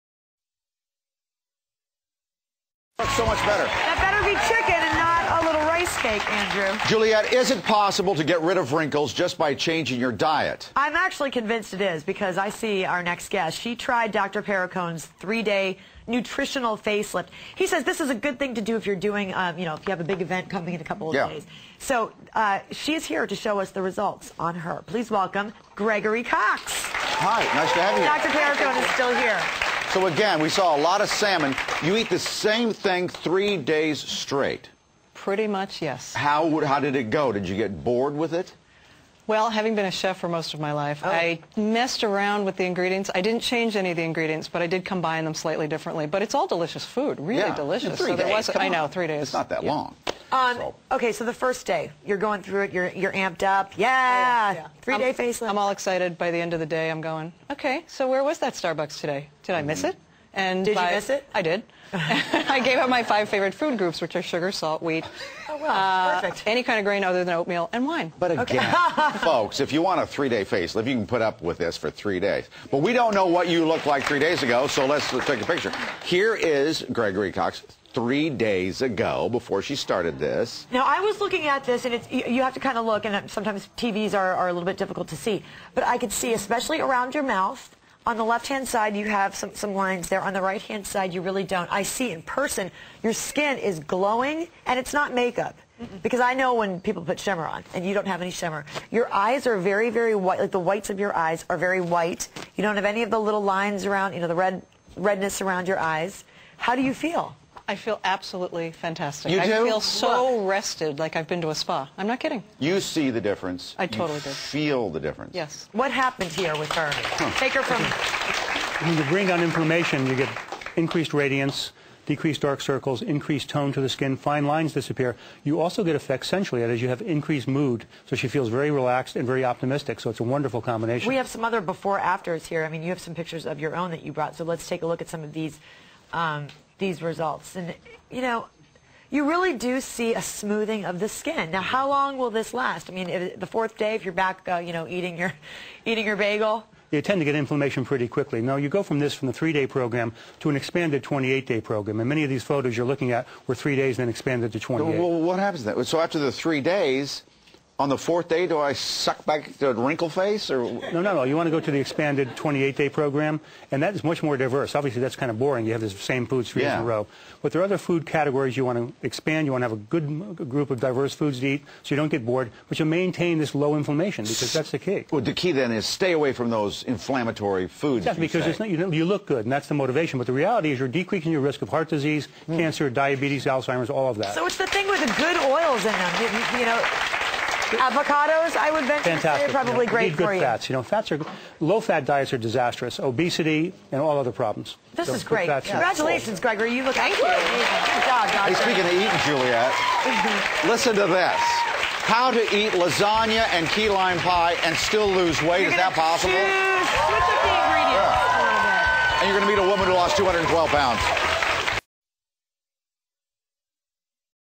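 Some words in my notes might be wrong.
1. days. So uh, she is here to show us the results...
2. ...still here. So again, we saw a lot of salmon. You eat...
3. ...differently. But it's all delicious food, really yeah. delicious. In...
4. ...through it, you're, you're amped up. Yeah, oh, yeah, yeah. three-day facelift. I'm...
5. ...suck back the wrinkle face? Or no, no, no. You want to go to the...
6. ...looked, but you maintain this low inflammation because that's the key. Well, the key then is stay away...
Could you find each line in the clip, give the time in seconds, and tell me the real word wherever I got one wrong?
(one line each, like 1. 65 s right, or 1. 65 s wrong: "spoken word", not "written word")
1. 21 s right
2. 28 s right
3. 45 s right
4. 52 s right
5. 158 s right
6. 172 s wrong: "bored", not "looked".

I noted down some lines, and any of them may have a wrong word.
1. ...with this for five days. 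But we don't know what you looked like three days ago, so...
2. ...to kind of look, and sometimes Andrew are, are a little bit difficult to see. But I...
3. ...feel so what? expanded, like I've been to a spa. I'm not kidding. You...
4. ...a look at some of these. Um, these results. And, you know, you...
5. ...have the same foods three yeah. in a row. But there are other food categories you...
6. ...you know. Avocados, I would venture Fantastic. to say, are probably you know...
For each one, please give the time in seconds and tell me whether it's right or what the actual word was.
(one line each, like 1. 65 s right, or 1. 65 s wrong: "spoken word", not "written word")
1. 71 s wrong: "three", not "five"
2. 82 s wrong: "TVs", not "Andrew"
3. 109 s wrong: "rested", not "expanded"
4. 134 s right
5. 165 s right
6. 186 s right.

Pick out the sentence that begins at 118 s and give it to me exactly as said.
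When you bring down inflammation, you get increased radiance, decreased dark circles, increased tone to the skin, fine lines disappear.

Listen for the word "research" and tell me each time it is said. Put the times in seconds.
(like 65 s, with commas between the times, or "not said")
not said.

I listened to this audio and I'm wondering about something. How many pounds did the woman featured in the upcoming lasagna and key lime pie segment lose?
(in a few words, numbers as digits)
212.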